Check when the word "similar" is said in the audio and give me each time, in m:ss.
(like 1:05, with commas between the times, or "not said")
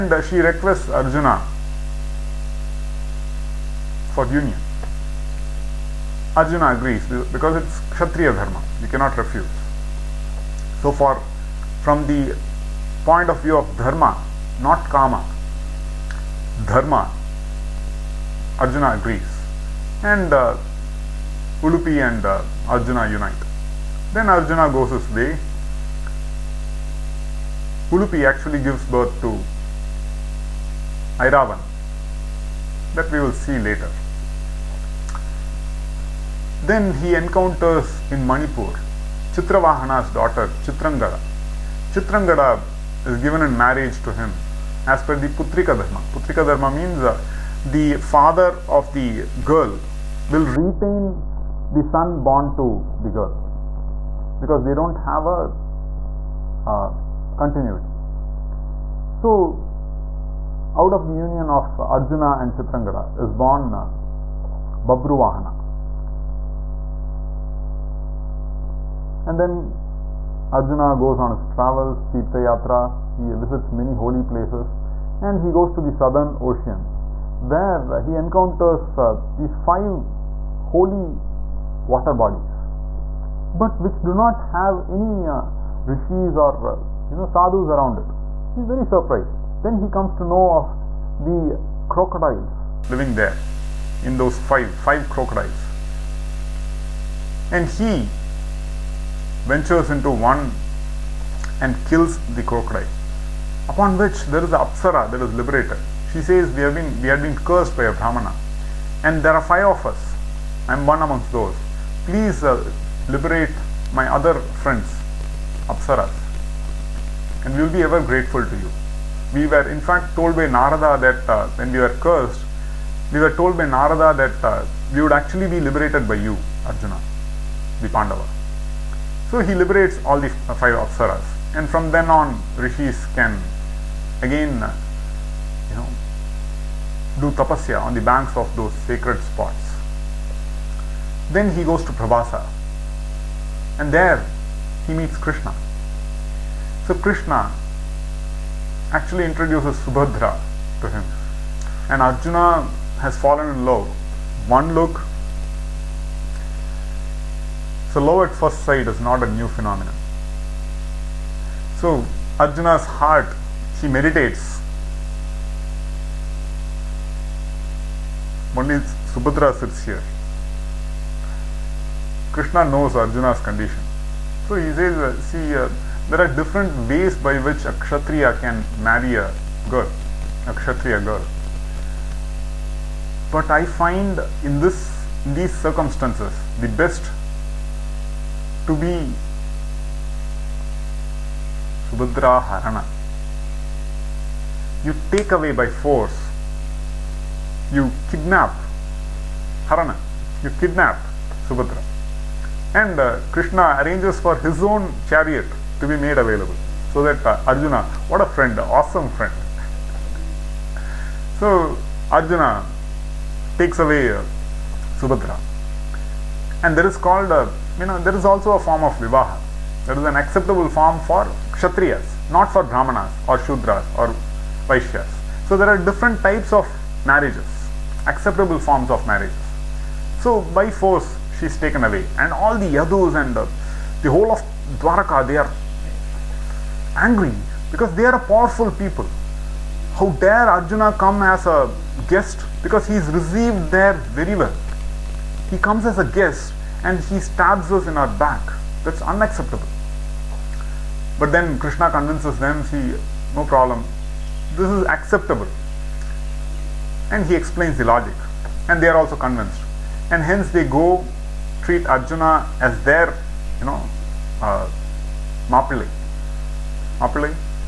not said.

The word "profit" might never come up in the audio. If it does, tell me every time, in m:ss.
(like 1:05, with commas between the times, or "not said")
not said.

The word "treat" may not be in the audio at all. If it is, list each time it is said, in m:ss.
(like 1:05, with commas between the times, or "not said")
4:21.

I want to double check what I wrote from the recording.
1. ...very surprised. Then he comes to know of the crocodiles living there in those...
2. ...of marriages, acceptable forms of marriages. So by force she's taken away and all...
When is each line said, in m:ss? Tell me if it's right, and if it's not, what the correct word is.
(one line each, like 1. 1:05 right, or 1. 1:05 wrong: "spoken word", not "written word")
1. 1:28 right
2. 3:46 right.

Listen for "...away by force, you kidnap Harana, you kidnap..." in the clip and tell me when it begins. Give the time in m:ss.
3:15.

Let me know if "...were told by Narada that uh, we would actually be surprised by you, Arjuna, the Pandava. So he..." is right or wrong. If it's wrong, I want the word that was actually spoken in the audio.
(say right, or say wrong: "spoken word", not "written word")
wrong: "liberated", not "surprised".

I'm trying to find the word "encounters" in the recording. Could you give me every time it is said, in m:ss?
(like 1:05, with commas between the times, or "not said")
0:37, 1:18.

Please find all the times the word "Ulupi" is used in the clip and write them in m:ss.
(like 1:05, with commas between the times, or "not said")
0:21, 0:27.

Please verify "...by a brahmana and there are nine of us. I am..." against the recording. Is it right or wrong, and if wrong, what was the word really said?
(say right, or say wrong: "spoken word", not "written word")
wrong: "five", not "nine".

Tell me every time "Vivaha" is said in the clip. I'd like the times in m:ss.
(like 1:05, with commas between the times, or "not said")
3:38.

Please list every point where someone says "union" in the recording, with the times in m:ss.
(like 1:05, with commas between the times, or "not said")
0:04, 1:01.